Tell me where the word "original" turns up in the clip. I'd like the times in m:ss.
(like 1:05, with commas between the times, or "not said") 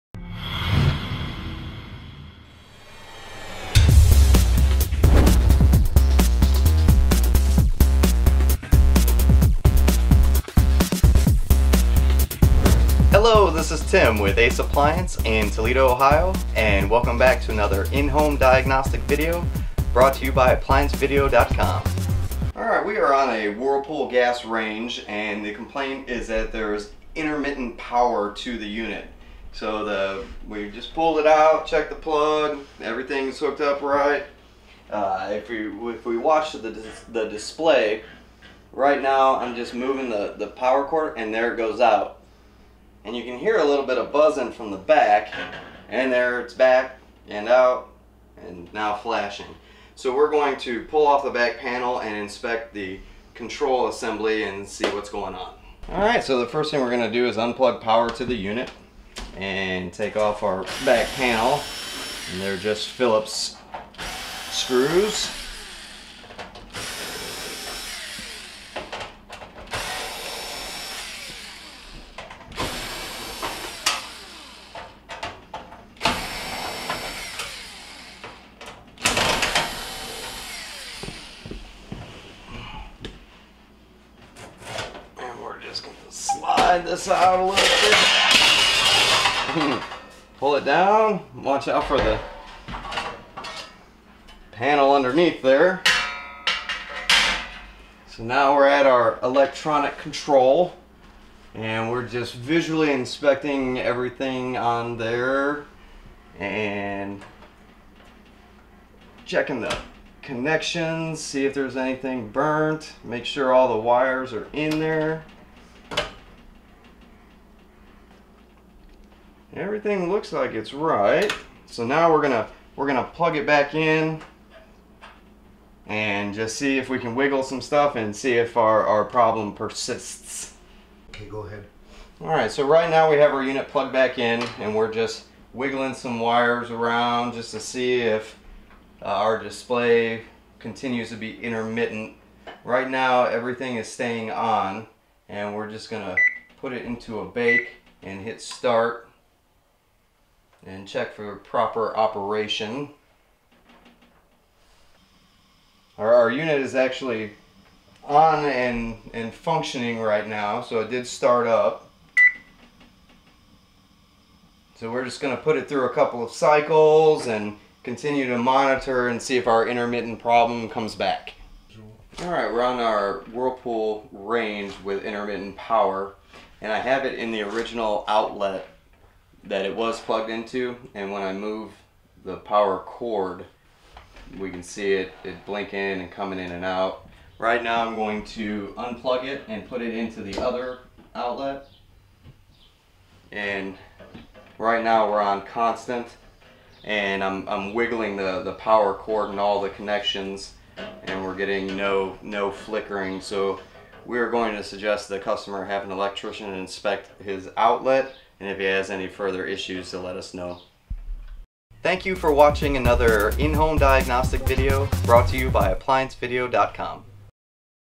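2:57.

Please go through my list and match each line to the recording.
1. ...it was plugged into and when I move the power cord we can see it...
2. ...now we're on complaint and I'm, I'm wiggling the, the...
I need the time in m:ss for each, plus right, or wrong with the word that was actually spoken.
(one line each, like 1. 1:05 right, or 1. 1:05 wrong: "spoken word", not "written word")
1. 2:59 right
2. 3:14 wrong: "constant", not "complaint".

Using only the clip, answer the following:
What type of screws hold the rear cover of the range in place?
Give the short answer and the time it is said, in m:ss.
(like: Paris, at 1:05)
Phillips, at 1:02.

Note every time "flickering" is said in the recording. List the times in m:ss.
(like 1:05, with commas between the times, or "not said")
3:22.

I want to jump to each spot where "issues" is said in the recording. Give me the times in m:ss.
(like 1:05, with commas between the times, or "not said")
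3:29.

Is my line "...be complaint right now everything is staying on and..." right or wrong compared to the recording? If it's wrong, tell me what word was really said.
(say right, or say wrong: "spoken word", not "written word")
wrong: "intermittent", not "complaint".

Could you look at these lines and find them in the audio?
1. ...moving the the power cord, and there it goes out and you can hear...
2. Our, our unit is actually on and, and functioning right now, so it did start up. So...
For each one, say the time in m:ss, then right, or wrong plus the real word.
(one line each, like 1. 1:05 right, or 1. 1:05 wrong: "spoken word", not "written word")
1. 0:39 right
2. 2:35 right.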